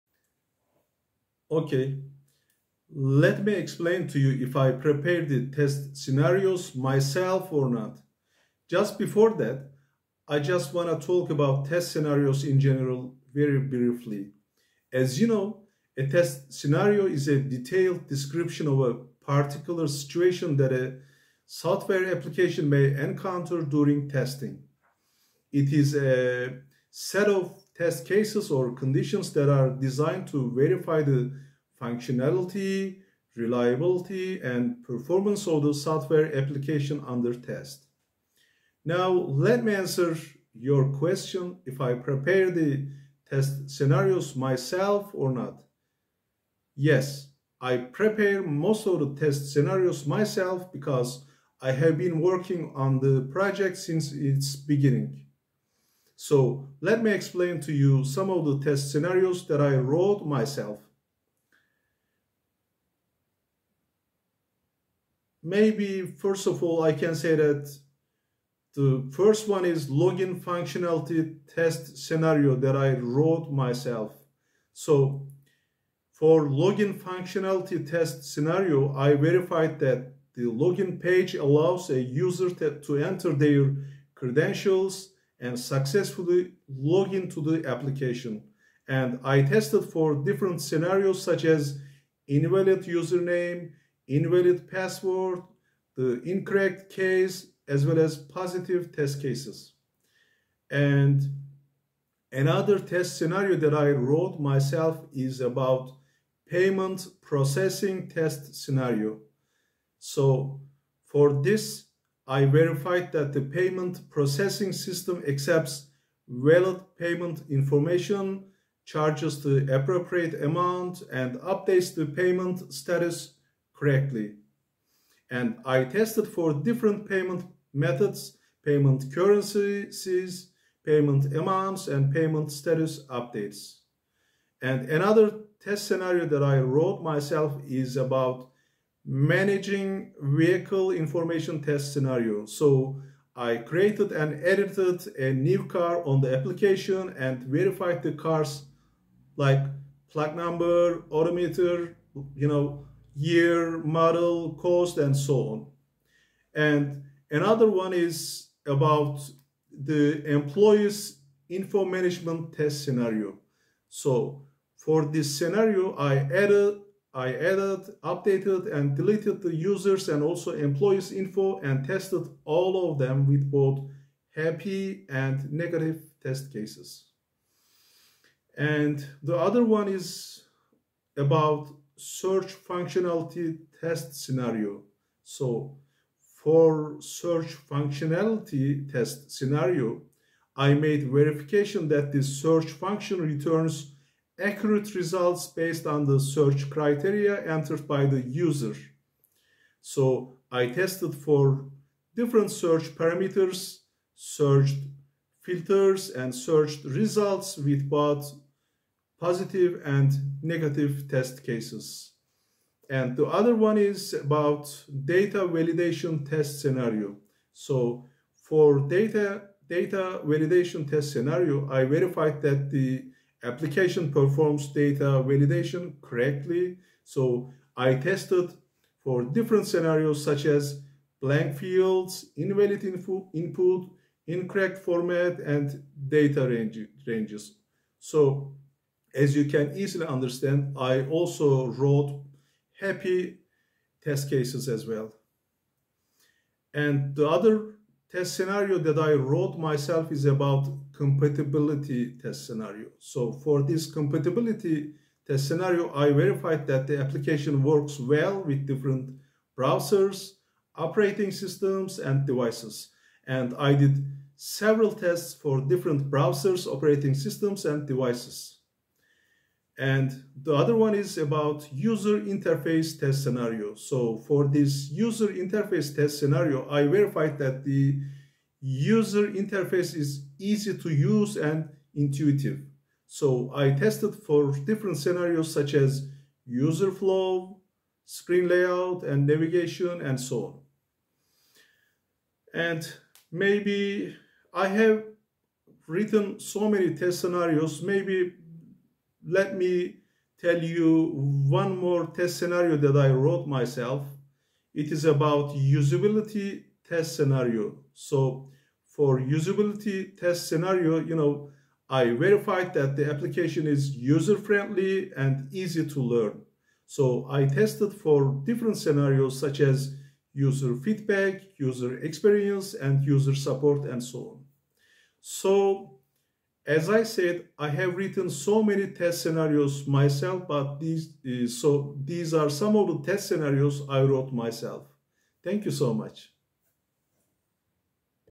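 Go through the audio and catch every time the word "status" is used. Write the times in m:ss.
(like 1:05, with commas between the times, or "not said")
2:02, 2:12.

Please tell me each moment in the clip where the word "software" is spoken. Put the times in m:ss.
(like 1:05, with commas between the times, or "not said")
0:21, 0:35.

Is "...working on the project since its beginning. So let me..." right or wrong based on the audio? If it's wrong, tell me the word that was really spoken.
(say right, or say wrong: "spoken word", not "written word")
right.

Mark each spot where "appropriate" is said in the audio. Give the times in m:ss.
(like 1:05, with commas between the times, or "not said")
1:59.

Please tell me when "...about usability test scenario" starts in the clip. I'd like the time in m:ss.
5:05.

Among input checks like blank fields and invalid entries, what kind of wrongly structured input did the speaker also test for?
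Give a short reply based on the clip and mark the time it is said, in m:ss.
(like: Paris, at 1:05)
Incorrect format, at 3:54.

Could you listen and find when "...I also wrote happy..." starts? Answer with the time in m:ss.
4:00.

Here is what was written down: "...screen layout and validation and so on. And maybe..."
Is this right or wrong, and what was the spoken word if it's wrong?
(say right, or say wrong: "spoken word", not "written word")
wrong: "navigation", not "validation".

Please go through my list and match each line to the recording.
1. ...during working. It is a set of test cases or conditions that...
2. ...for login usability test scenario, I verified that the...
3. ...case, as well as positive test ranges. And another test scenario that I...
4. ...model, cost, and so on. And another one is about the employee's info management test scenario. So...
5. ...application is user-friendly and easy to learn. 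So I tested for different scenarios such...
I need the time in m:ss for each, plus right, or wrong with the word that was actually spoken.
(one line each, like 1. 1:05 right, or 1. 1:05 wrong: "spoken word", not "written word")
1. 0:23 wrong: "testing", not "working"
2. 1:16 wrong: "functionality", not "usability"
3. 1:36 wrong: "cases", not "ranges"
4. 2:33 right
5. 5:13 right.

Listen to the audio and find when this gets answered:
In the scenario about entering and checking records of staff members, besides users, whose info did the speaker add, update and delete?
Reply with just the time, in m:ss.
2:50.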